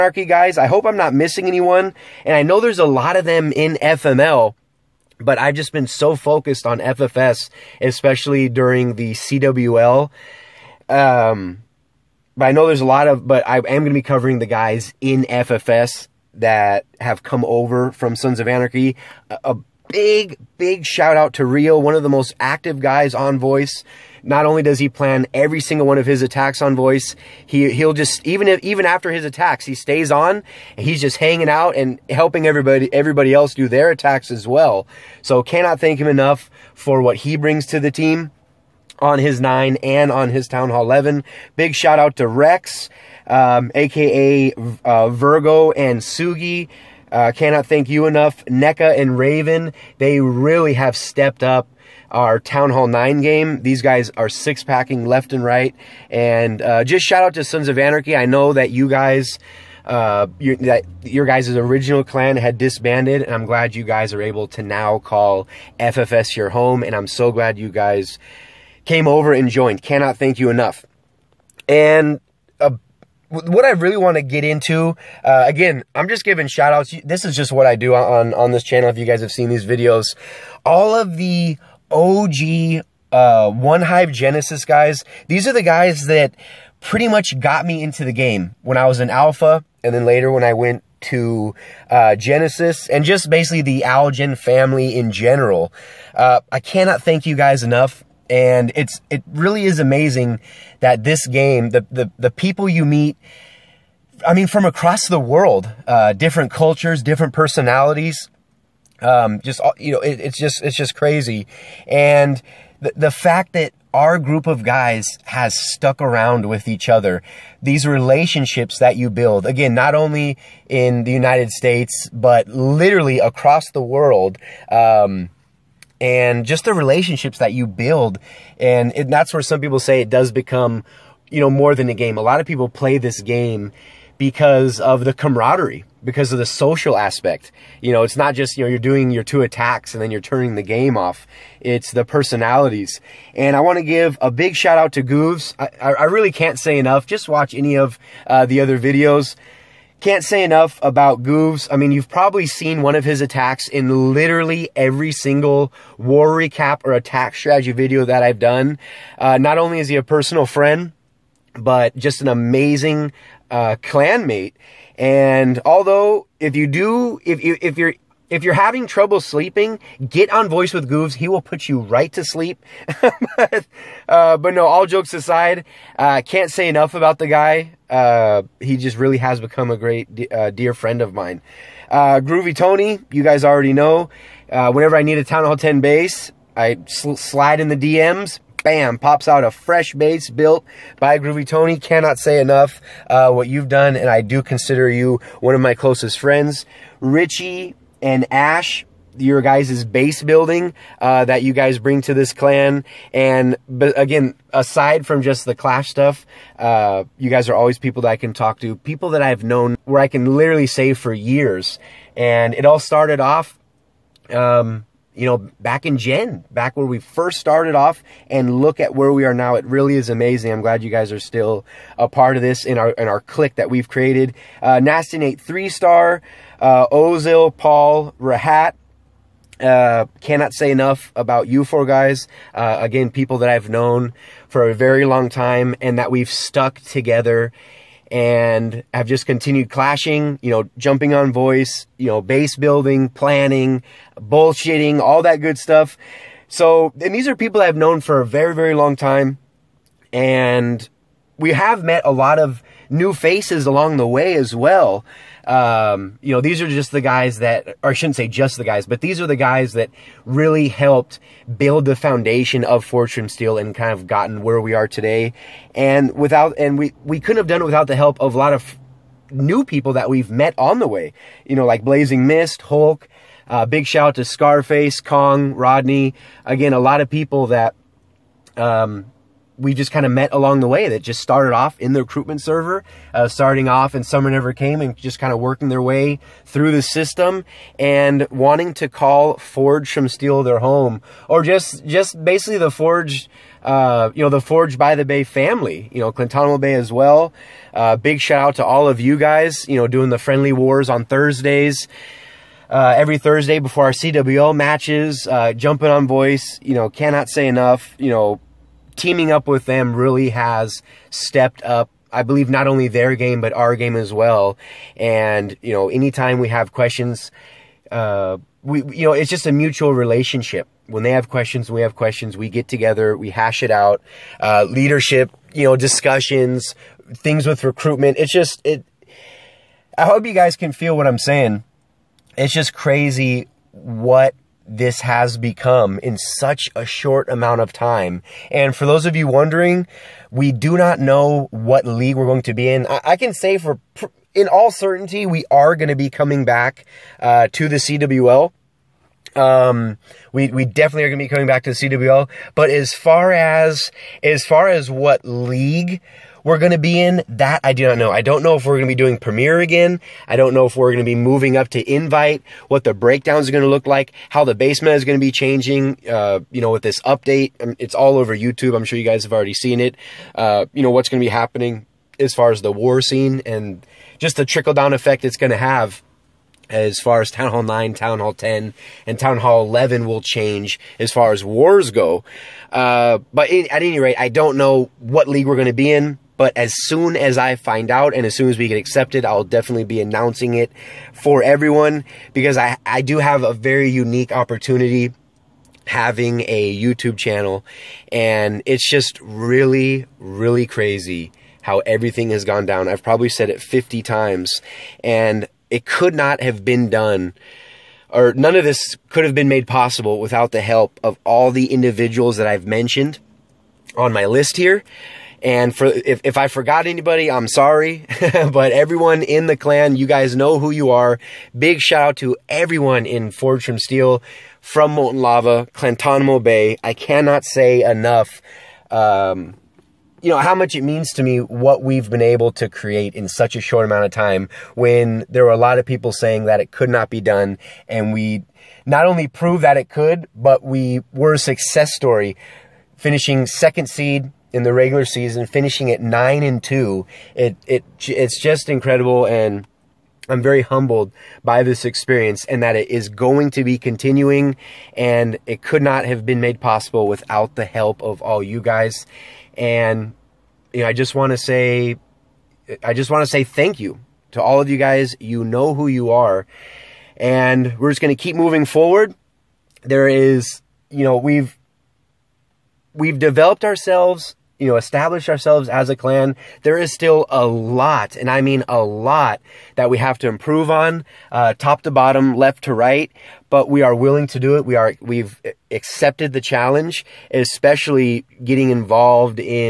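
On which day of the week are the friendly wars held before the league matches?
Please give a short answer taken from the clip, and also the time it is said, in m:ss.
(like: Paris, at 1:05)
Thursday, at 5:01.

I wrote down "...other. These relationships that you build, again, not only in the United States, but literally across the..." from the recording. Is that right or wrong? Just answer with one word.
right.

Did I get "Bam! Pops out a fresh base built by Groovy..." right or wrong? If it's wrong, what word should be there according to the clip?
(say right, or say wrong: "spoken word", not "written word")
right.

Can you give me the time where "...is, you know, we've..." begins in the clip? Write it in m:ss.
7:50.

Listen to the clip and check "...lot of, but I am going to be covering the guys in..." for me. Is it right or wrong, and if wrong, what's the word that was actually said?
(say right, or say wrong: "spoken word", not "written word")
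right.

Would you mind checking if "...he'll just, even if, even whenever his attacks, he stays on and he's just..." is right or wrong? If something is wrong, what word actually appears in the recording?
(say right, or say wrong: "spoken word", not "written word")
wrong: "after", not "whenever".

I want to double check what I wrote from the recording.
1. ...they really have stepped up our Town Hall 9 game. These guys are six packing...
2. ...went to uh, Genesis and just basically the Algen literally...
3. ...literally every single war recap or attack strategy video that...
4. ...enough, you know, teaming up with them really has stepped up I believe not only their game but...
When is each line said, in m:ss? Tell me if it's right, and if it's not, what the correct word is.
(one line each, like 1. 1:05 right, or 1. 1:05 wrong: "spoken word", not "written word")
1. 0:49 right
2. 1:30 wrong: "family", not "literally"
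3. 2:34 right
4. 5:07 right.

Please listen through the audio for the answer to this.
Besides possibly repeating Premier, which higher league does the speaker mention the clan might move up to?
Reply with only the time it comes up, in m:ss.
6:01.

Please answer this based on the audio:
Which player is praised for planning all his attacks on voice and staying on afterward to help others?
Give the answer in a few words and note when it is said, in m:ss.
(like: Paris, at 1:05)
Rio, at 0:21.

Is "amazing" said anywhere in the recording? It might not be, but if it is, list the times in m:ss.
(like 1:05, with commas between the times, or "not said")
1:39, 2:42, 3:40.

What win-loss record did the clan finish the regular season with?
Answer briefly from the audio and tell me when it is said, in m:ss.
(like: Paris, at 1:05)
9 and 2, at 7:26.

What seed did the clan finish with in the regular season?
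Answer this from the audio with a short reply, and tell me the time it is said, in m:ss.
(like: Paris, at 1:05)
second, at 7:23.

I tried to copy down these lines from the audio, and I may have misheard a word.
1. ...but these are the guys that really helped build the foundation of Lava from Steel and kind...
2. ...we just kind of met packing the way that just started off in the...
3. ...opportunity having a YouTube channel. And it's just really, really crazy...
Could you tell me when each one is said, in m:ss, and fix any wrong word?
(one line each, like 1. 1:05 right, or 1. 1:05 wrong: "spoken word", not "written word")
1. 4:18 wrong: "Forged", not "Lava"
2. 4:39 wrong: "along", not "packing"
3. 6:34 right.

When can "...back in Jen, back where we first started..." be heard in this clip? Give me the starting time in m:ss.
3:35.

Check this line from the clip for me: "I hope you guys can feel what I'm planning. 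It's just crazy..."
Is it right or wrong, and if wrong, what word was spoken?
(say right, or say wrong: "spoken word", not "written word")
wrong: "saying", not "planning".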